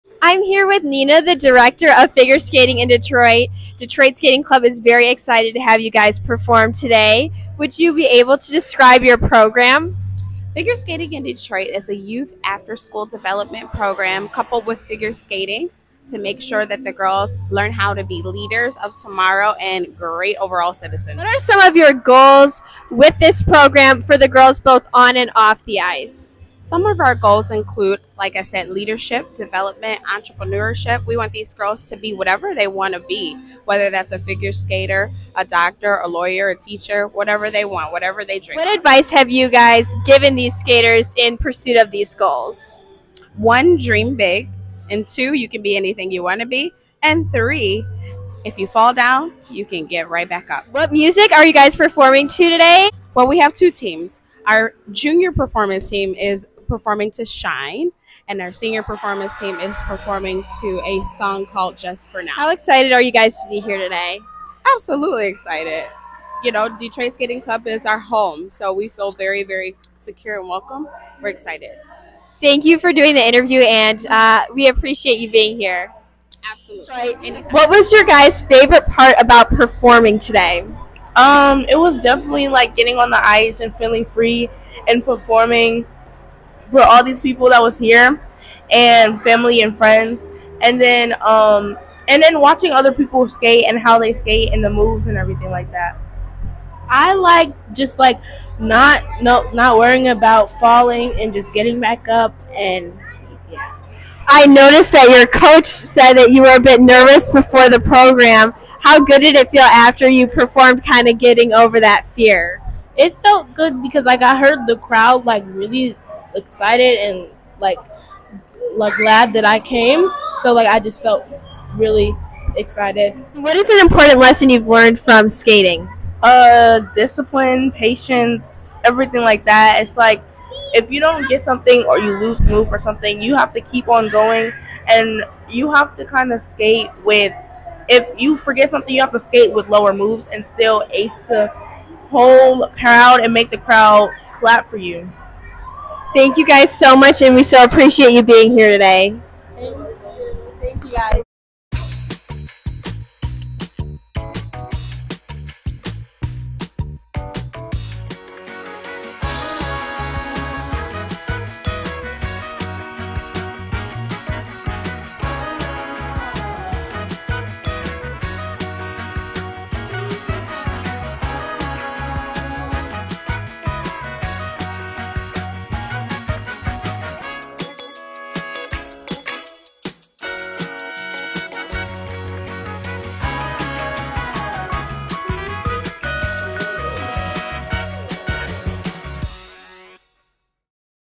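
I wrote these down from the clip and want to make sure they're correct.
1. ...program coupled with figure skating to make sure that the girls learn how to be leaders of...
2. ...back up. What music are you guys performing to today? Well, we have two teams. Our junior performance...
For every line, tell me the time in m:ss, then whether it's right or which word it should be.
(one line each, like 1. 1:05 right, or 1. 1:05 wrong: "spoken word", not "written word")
1. 0:13 right
2. 0:50 right.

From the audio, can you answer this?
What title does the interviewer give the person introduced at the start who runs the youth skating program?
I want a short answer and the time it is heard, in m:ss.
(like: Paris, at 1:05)
Director of Figure Skating in Detroit, at 0:01.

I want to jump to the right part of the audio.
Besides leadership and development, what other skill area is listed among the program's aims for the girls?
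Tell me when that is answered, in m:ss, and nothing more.
0:30.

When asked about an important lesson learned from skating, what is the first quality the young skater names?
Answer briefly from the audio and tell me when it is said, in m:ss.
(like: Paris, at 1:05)
Discipline, at 2:06.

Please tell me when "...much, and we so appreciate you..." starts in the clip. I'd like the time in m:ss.
2:26.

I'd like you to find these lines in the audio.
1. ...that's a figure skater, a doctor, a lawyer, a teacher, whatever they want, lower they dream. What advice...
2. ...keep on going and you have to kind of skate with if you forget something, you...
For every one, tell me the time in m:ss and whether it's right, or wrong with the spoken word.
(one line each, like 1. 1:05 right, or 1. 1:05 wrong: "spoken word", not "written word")
1. 0:33 wrong: "whatever", not "lower"
2. 2:13 right.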